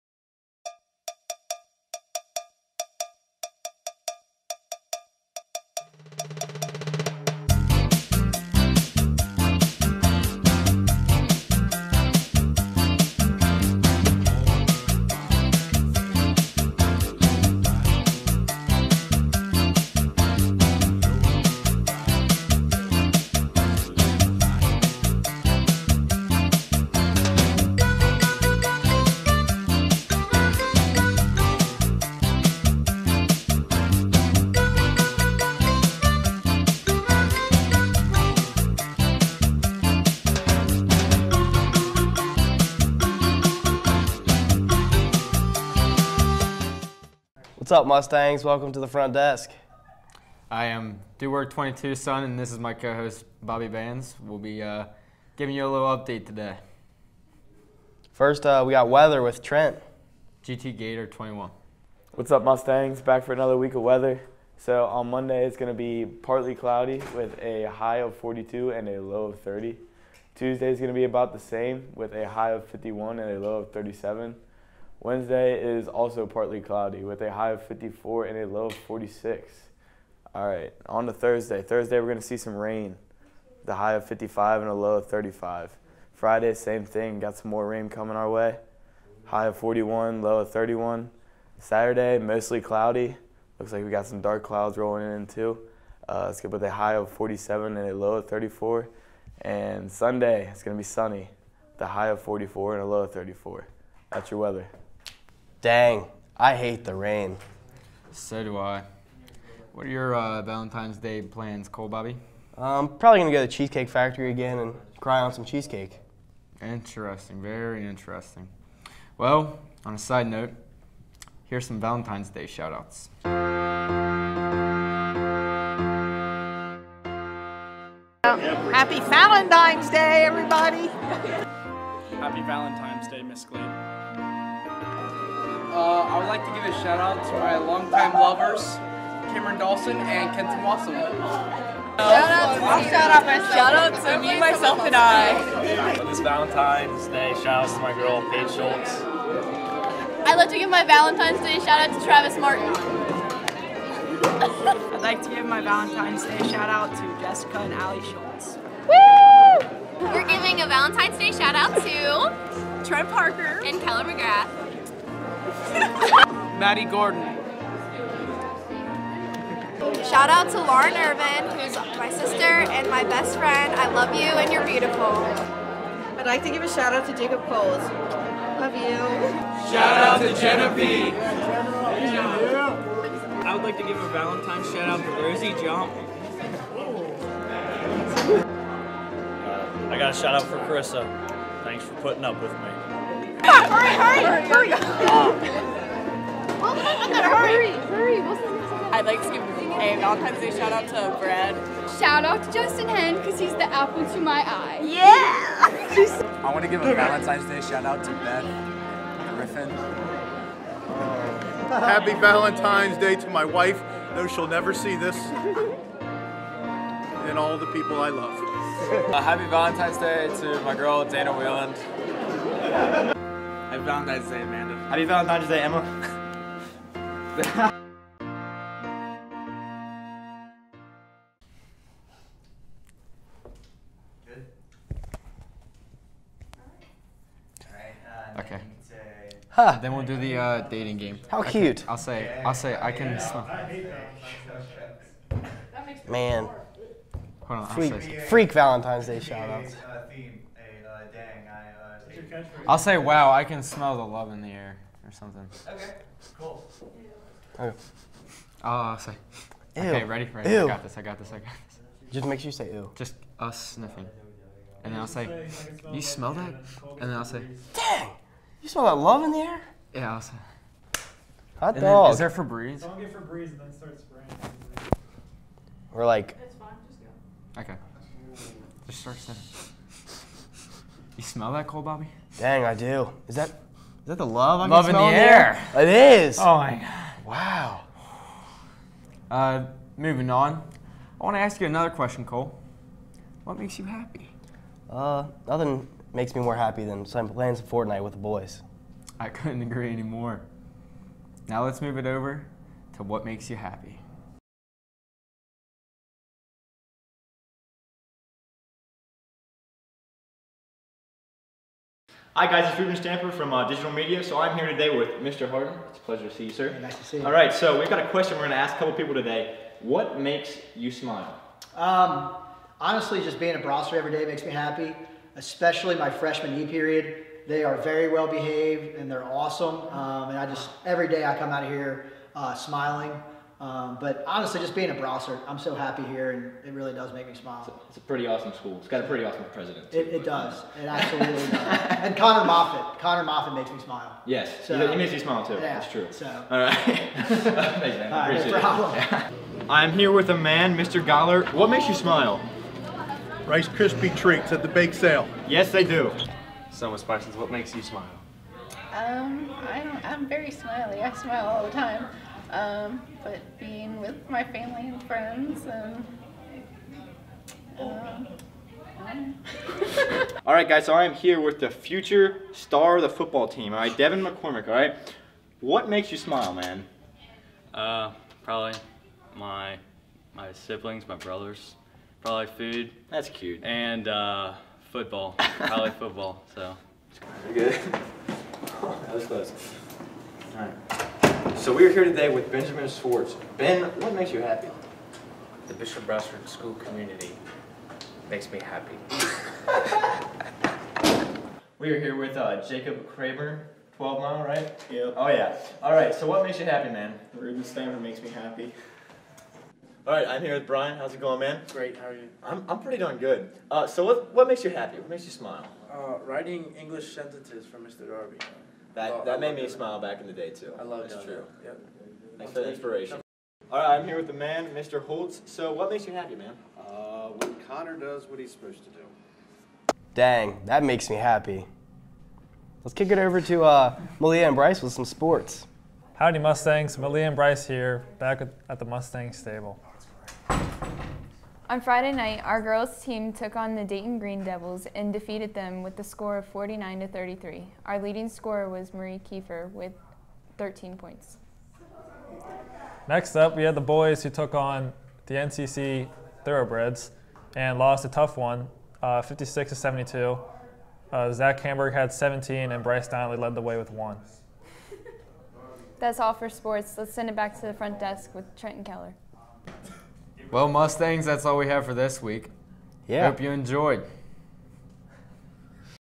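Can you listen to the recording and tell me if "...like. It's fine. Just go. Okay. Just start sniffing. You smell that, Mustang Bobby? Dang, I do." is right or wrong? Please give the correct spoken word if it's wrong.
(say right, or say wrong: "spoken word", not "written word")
wrong: "Cole", not "Mustang".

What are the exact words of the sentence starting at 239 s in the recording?
Then we'll do the uh, dating game.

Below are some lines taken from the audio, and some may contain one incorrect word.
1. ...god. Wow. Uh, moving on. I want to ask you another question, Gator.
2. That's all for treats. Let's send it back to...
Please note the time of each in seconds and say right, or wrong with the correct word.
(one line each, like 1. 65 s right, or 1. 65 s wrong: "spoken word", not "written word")
1. 286 s wrong: "Cole", not "Gator"
2. 465 s wrong: "sports", not "treats".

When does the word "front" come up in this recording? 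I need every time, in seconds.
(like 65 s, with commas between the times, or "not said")
48 s, 467 s.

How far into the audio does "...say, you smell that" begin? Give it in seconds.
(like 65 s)
265 s.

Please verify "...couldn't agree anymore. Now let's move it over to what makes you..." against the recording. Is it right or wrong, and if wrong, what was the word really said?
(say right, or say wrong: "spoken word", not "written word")
right.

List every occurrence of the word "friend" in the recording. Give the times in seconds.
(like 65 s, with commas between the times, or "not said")
173 s, 365 s.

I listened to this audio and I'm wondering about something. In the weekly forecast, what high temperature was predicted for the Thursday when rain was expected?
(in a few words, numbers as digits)
55.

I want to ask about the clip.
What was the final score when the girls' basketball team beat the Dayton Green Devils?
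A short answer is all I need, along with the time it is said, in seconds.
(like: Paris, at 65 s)
49 to 33, at 446 s.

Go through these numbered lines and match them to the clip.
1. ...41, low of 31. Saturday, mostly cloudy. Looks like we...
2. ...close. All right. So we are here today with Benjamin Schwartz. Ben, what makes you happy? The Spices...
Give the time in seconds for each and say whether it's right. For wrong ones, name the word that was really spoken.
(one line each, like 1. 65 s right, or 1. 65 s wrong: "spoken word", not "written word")
1. 89 s right
2. 389 s wrong: "Bishop", not "Spices".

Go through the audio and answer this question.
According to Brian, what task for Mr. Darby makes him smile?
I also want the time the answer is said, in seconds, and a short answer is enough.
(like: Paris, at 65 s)
Writing English sentences, at 416 s.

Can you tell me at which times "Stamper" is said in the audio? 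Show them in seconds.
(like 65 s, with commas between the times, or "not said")
312 s, 407 s.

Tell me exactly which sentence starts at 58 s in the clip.
First, uh, we got weather with Trent.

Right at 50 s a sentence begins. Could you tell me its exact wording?
I am Dewar 22 Son, and this is my co host, Bobby Vans.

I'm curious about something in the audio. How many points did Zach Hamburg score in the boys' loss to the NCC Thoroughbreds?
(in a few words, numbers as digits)
17.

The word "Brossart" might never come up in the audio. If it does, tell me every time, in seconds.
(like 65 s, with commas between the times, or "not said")
323 s, 334 s, 396 s.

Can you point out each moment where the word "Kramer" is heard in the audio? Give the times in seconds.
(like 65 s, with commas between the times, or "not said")
403 s.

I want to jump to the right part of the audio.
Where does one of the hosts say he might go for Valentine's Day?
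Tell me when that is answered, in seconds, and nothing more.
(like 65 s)
113 s.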